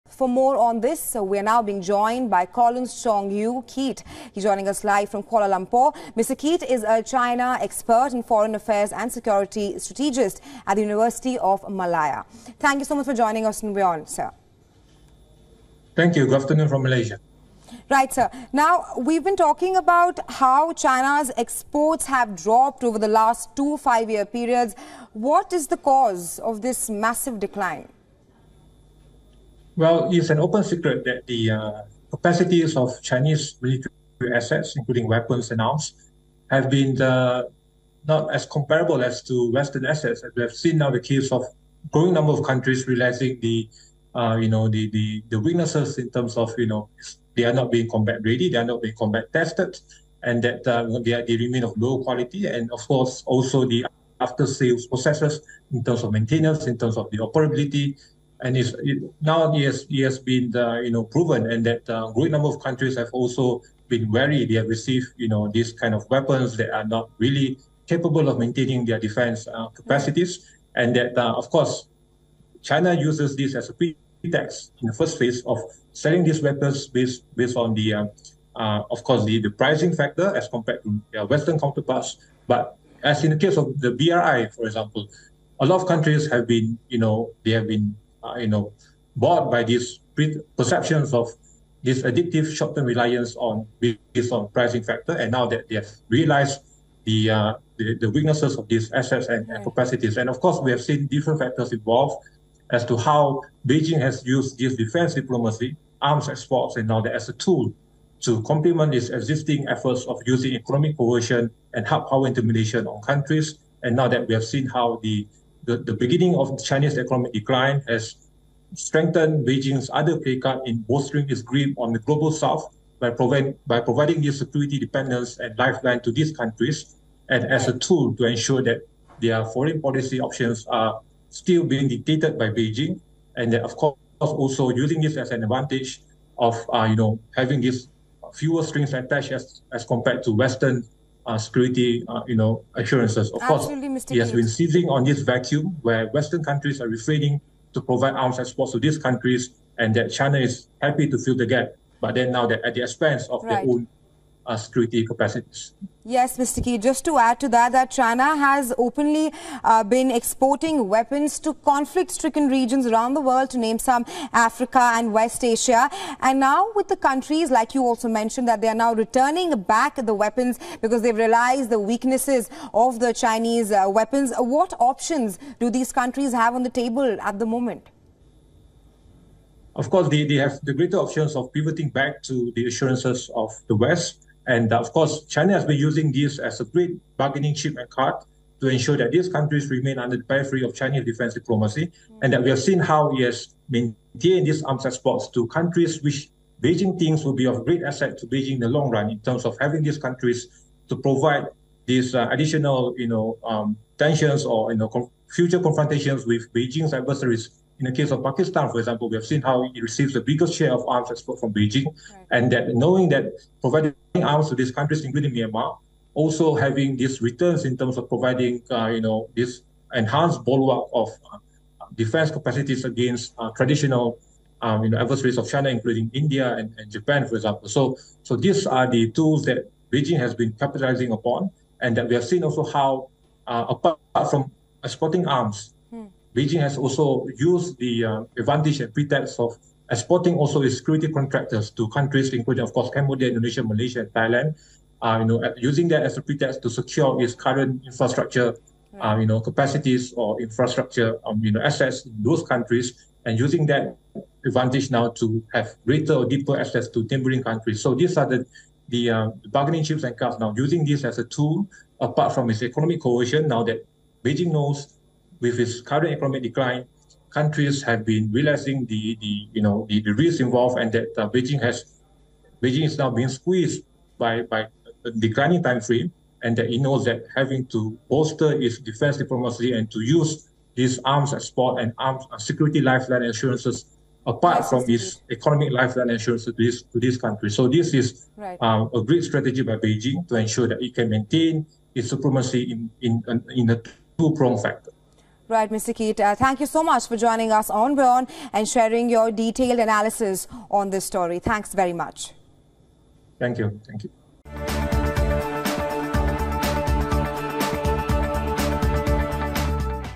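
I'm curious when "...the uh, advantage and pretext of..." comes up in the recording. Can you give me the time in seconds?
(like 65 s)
237 s.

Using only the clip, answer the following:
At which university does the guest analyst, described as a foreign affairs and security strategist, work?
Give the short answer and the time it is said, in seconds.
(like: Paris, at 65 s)
University of Malaya, at 10 s.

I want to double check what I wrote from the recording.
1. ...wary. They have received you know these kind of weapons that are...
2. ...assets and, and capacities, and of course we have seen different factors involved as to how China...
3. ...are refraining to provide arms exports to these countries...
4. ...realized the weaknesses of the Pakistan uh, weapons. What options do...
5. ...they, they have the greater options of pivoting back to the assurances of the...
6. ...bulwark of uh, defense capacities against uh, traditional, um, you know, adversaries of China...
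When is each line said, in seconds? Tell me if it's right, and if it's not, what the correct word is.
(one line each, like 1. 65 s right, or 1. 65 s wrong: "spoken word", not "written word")
1. 64 s right
2. 98 s wrong: "Beijing", not "China"
3. 146 s right
4. 171 s wrong: "Chinese", not "Pakistan"
5. 180 s right
6. 220 s right.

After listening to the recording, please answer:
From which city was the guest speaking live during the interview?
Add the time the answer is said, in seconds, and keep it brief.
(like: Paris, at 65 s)
Kuala Lumpur, at 5 s.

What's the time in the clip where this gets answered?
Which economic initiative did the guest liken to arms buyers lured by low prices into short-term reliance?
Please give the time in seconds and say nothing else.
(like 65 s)
83 s.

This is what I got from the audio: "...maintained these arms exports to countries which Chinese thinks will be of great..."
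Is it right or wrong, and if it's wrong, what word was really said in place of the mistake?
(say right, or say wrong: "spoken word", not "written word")
wrong: "Beijing", not "Chinese".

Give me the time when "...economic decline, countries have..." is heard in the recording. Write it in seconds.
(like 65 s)
266 s.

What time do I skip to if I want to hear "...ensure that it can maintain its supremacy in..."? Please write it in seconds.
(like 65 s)
290 s.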